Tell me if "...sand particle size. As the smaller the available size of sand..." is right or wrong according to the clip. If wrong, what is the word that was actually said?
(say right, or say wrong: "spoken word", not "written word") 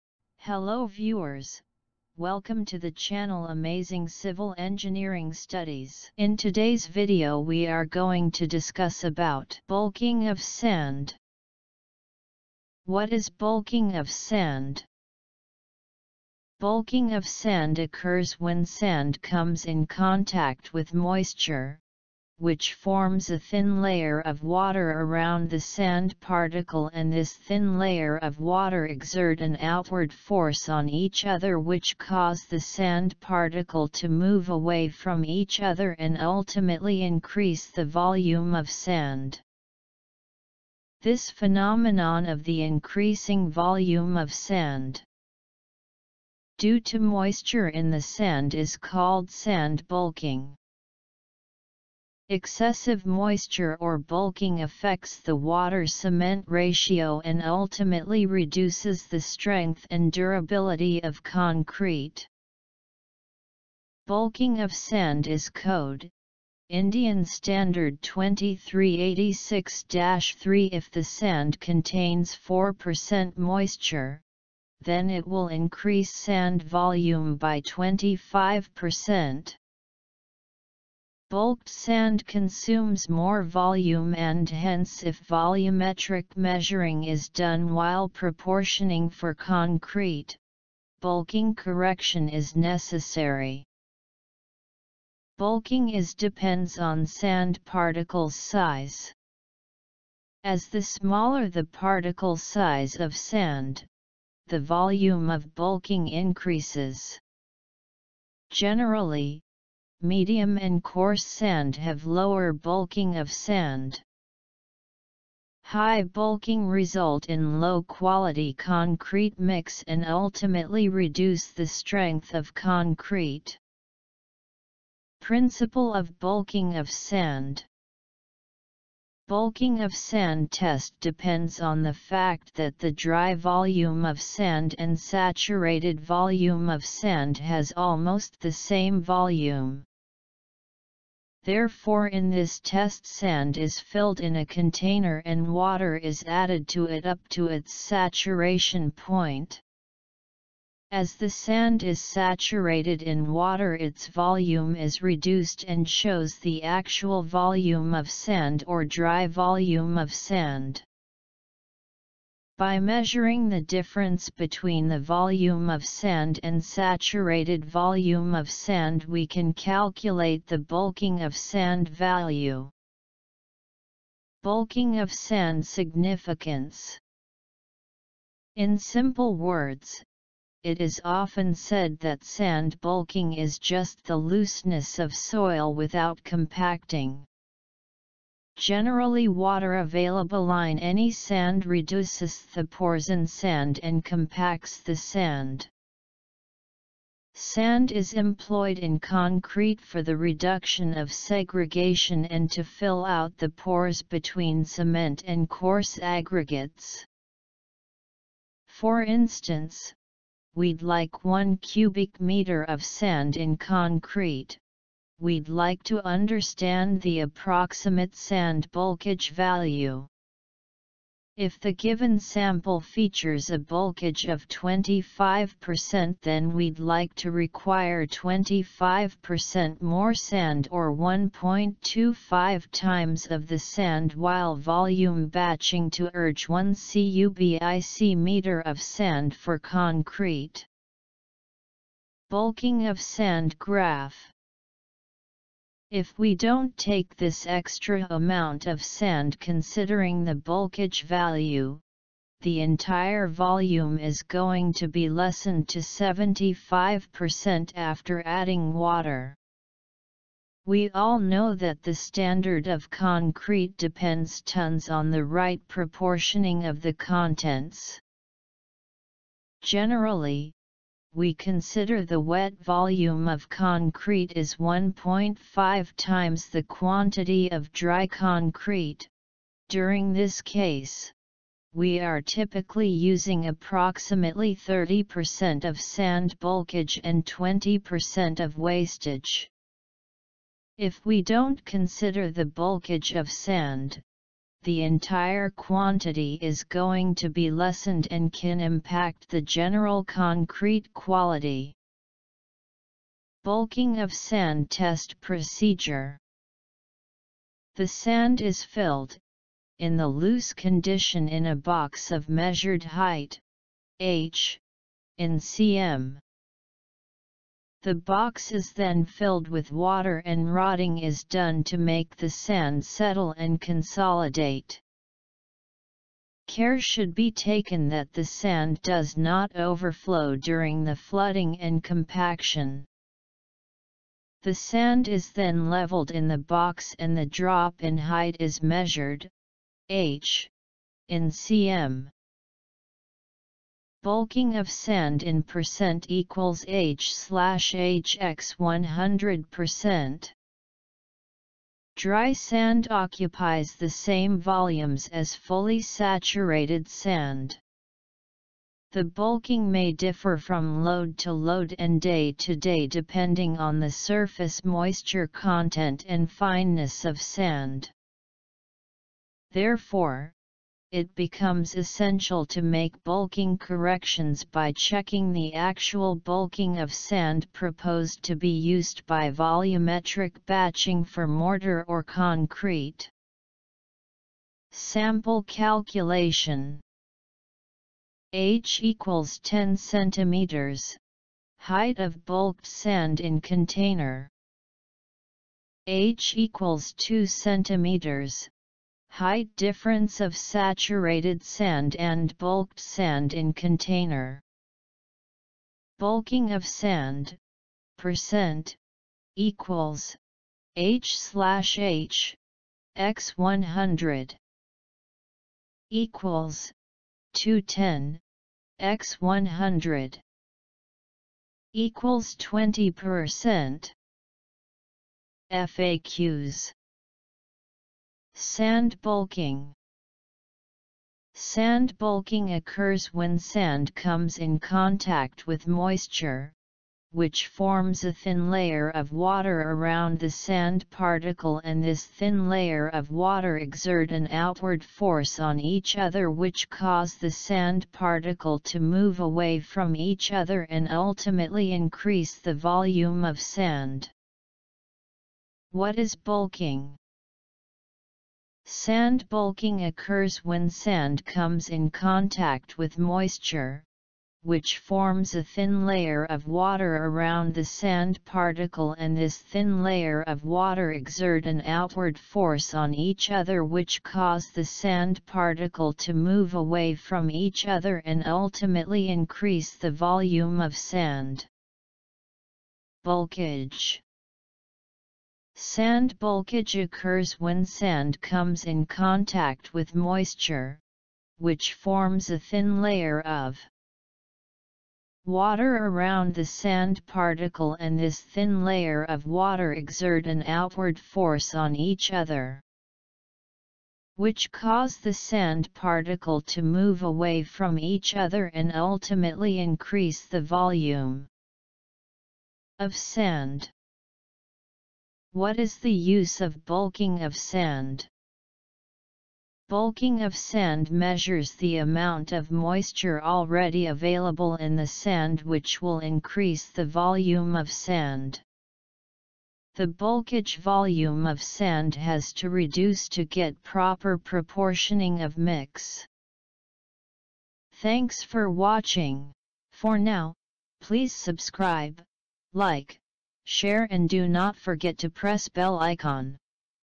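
wrong: "particle", not "available".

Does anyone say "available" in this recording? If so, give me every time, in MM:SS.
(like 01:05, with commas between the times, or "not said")
03:09, 08:43.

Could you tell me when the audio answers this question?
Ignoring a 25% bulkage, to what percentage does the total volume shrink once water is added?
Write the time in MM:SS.
04:15.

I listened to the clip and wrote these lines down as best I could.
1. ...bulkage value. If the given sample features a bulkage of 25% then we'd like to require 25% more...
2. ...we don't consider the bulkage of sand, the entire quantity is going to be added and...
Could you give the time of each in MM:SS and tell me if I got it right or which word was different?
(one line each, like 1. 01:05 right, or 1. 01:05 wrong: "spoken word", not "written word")
1. 03:38 right
2. 04:51 wrong: "lessened", not "added".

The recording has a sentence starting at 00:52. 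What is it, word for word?
Excessive moisture or bulking affects the water-cement ratio and ultimately reduces the strength and durability of concrete.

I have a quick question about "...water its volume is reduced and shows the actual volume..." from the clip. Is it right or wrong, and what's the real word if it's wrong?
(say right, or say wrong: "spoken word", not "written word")
right.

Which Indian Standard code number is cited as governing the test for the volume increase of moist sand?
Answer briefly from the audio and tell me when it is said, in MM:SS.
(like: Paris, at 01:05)
IS 2386-3, at 01:06.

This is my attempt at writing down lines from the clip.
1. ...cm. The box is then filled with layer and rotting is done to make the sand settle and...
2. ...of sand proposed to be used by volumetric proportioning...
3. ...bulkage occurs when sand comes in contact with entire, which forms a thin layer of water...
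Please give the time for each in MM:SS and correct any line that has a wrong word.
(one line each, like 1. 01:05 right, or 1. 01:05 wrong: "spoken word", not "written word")
1. 05:15 wrong: "water", not "layer"
2. 06:16 wrong: "batching", not "proportioning"
3. 08:06 wrong: "moisture", not "entire".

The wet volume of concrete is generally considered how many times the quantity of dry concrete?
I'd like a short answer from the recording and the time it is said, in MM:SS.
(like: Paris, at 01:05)
1.5 times, at 04:34.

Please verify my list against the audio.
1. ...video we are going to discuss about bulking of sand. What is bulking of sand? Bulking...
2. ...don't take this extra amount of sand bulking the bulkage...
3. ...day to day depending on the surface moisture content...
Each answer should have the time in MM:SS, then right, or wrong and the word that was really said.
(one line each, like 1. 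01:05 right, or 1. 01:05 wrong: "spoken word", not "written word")
1. 00:06 right
2. 04:06 wrong: "considering", not "bulking"
3. 06:02 right.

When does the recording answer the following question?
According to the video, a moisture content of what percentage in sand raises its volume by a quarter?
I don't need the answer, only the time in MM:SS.
01:12.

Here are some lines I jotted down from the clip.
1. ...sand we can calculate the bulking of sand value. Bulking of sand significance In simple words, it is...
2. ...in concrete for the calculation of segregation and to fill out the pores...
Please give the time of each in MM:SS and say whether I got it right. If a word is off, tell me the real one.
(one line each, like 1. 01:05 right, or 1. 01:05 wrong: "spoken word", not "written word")
1. 02:48 right
2. 03:18 wrong: "reduction", not "calculation".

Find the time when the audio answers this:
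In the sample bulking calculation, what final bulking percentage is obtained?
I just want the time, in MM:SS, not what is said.
07:02.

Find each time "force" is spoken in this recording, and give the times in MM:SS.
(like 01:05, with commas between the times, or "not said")
00:30, 07:24, 07:52, 08:20.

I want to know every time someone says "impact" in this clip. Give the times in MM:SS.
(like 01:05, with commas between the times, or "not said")
04:58.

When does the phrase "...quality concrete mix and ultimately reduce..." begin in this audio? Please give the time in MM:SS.
01:57.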